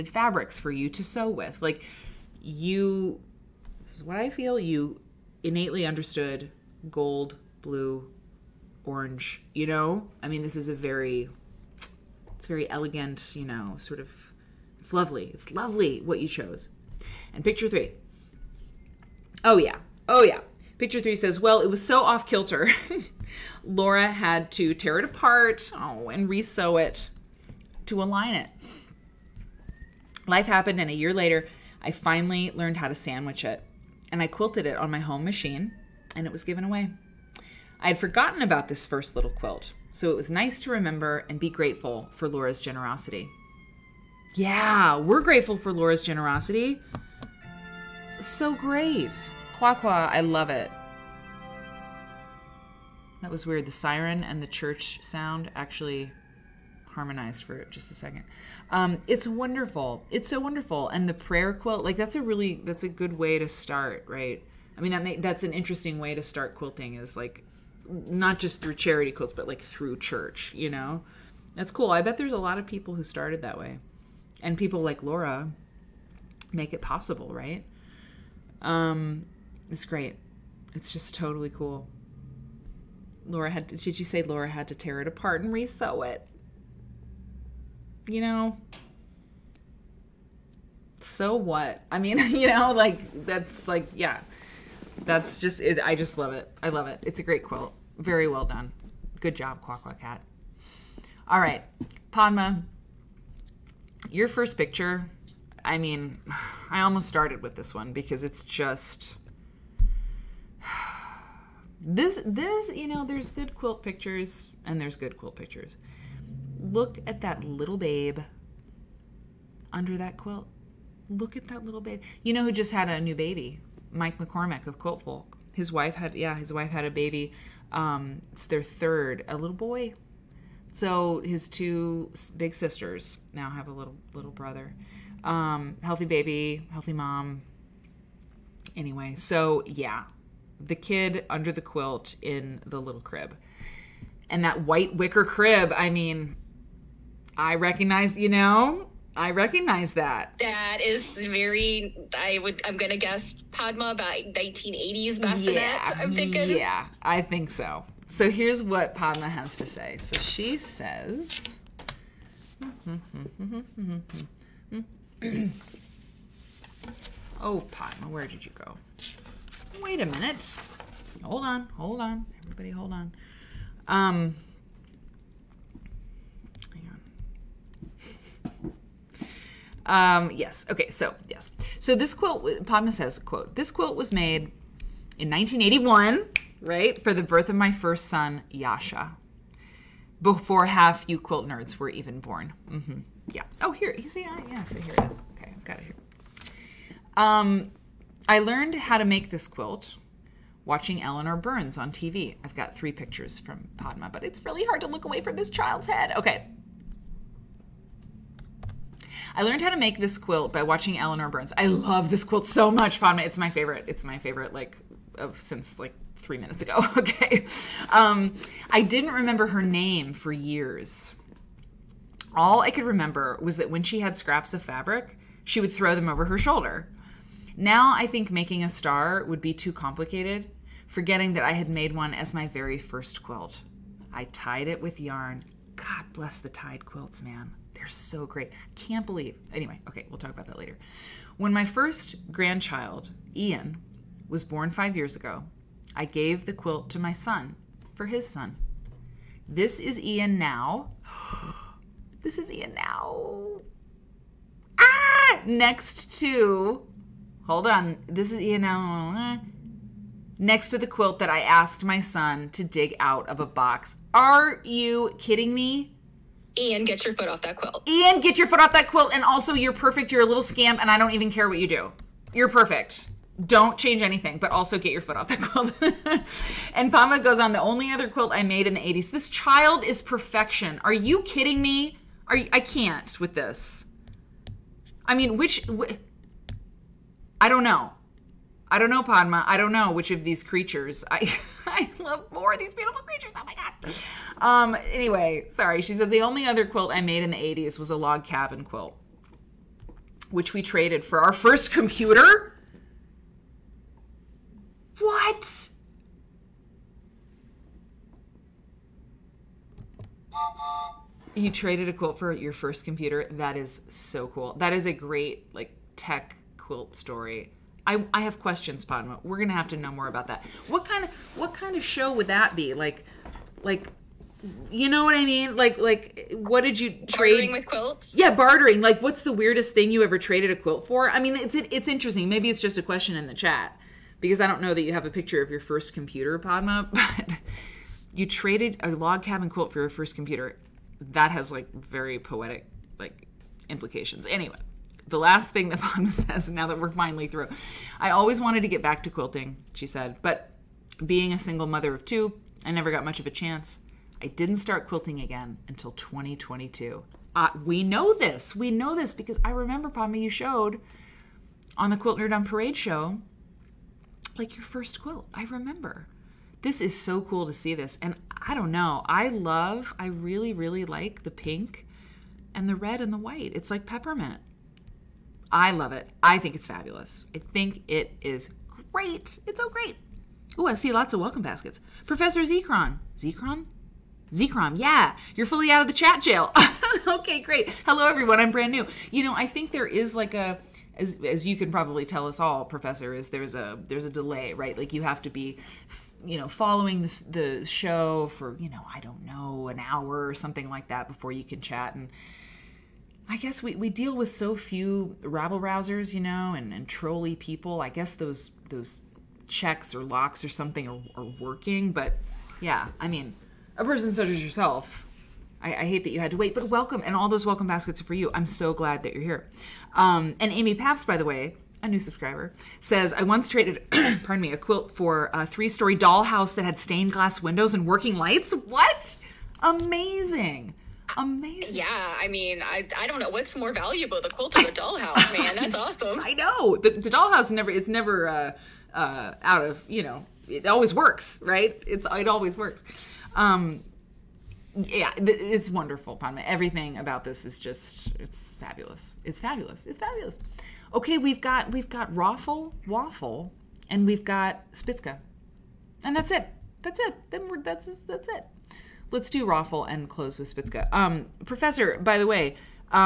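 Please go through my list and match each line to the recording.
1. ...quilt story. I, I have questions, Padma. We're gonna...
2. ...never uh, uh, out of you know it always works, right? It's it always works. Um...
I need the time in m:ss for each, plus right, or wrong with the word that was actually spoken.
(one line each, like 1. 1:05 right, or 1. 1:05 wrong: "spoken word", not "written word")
1. 5:16 right
2. 7:17 right.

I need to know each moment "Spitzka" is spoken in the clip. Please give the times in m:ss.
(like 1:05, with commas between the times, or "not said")
7:34, 7:40.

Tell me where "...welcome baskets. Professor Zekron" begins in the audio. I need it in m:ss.
6:21.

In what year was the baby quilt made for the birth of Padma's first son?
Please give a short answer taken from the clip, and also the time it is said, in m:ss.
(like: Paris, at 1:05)
1981, at 3:05.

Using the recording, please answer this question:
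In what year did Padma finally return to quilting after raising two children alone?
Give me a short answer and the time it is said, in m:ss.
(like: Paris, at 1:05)
2022, at 5:55.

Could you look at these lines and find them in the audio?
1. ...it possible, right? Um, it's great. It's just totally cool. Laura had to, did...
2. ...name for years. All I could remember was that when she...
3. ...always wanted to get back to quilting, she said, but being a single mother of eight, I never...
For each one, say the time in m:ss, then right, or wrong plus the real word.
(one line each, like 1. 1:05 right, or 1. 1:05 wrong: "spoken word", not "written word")
1. 1:16 right
2. 3:39 right
3. 5:48 wrong: "two", not "eight".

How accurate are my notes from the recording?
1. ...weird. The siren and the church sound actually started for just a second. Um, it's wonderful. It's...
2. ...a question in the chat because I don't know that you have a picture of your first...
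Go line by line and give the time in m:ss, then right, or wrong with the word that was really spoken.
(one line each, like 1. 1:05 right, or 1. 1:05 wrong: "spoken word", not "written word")
1. 0:53 wrong: "harmonized", not "started"
2. 5:32 right.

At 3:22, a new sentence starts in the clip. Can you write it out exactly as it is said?
I've got three pictures from Padma, but it's really hard to look away from this child's head.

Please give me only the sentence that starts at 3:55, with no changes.
God bless the tied quilts, man.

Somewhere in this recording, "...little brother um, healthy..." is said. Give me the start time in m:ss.
2:14.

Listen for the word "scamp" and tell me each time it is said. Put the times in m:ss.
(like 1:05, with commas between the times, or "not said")
4:30.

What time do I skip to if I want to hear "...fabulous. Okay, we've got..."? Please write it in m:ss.
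7:29.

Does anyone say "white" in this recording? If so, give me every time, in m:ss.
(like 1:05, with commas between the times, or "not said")
2:24, 6:13.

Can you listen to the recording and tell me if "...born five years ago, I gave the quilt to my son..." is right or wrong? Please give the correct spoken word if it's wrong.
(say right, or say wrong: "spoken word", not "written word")
right.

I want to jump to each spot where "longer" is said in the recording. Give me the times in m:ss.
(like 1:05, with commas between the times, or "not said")
not said.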